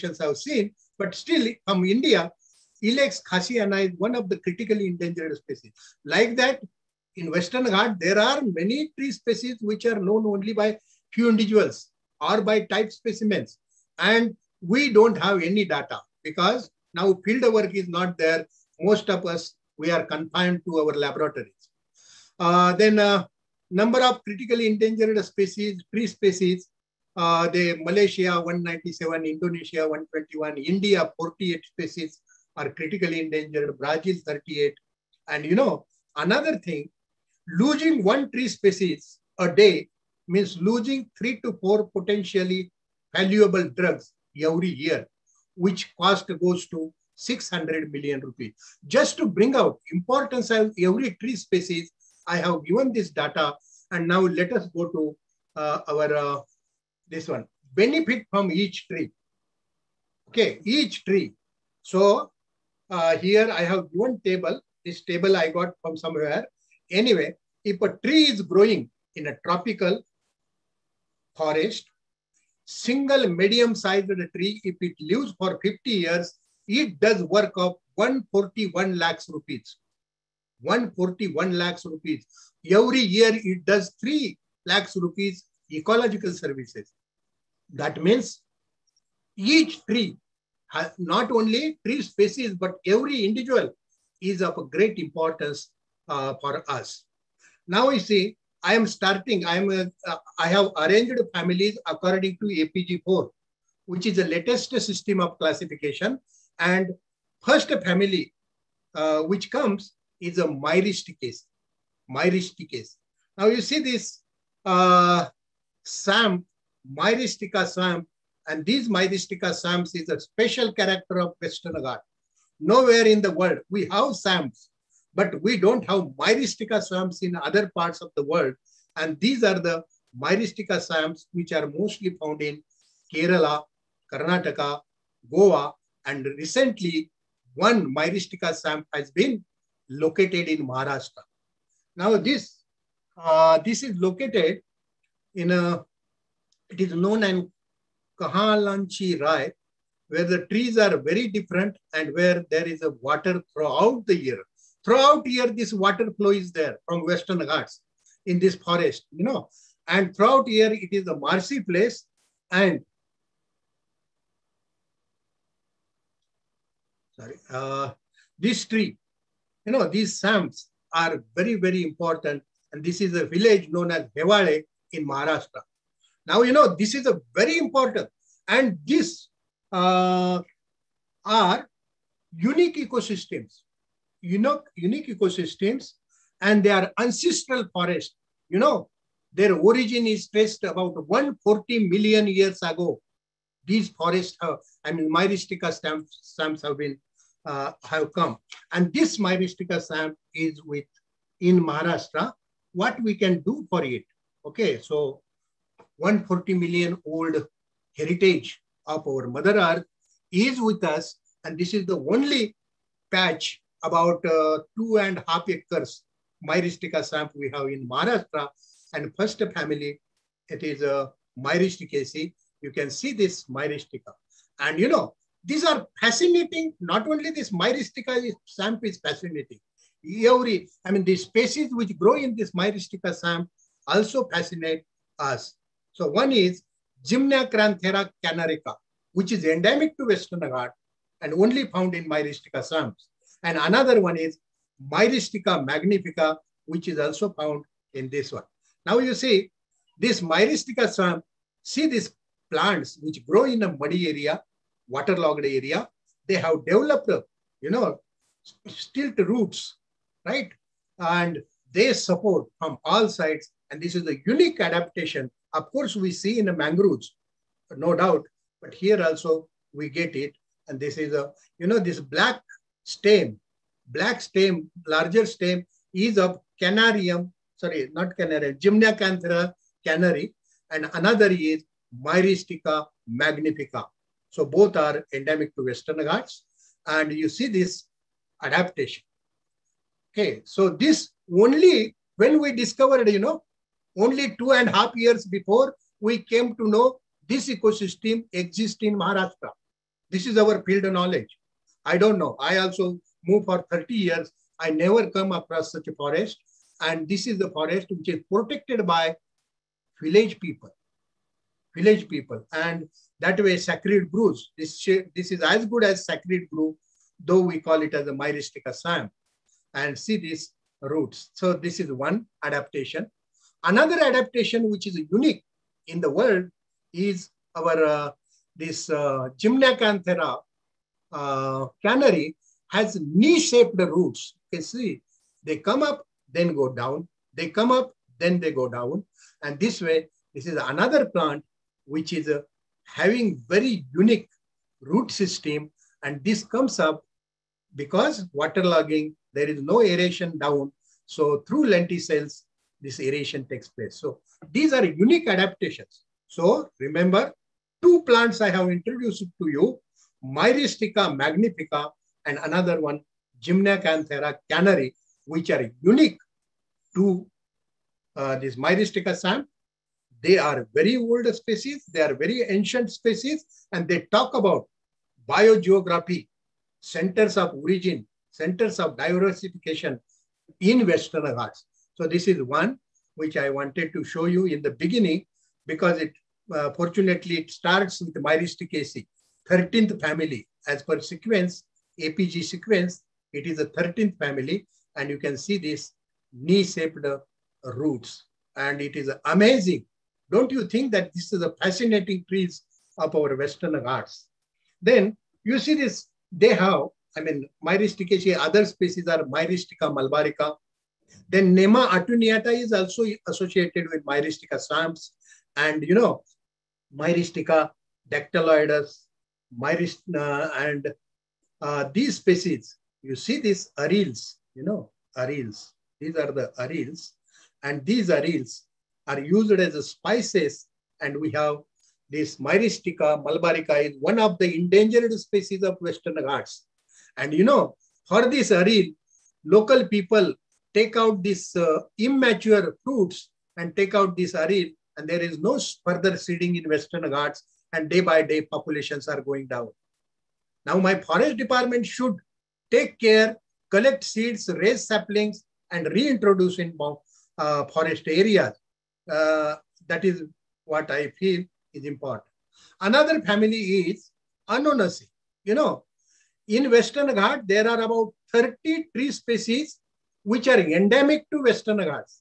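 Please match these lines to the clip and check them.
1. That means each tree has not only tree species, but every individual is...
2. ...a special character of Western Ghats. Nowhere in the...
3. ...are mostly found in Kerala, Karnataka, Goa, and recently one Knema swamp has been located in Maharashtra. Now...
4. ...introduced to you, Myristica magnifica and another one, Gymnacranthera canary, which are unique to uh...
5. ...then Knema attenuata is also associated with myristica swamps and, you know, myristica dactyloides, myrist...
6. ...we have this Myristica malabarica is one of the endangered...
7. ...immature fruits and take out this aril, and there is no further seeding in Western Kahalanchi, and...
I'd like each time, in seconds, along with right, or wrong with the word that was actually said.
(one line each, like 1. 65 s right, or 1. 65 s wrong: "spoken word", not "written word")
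1. 87 s right
2. 120 s right
3. 131 s wrong: "Myristica", not "Knema"
4. 358 s right
5. 411 s right
6. 431 s right
7. 441 s wrong: "Ghats", not "Kahalanchi".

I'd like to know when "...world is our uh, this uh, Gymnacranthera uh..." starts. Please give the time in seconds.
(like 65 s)
326 s.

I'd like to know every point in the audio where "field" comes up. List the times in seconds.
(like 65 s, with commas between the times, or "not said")
17 s, 300 s.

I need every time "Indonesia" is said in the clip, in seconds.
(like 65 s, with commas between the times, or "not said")
29 s.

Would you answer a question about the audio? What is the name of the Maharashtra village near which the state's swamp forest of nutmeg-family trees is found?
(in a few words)
Hevale.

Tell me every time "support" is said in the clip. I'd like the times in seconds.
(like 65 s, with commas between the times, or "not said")
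261 s.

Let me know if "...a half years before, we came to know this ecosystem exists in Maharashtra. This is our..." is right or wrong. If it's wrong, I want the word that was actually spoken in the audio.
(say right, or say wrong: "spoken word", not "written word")
right.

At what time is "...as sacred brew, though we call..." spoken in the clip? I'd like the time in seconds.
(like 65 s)
315 s.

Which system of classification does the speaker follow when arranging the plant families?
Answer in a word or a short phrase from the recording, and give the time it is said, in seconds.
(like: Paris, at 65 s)
APG4, at 102 s.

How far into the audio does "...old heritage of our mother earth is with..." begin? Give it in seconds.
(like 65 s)
207 s.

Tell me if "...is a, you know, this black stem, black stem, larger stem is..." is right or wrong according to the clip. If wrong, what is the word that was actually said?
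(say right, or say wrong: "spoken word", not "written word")
right.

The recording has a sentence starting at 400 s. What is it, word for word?
Don't you think that this is a fascinating trees of our Western Ghats?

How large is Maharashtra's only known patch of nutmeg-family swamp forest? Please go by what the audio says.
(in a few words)
2.5 acres.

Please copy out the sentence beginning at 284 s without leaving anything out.
So both are endemic to Western Ghats.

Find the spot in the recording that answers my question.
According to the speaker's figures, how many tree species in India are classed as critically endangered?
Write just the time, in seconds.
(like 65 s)
30 s.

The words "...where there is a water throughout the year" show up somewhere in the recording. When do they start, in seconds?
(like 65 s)
152 s.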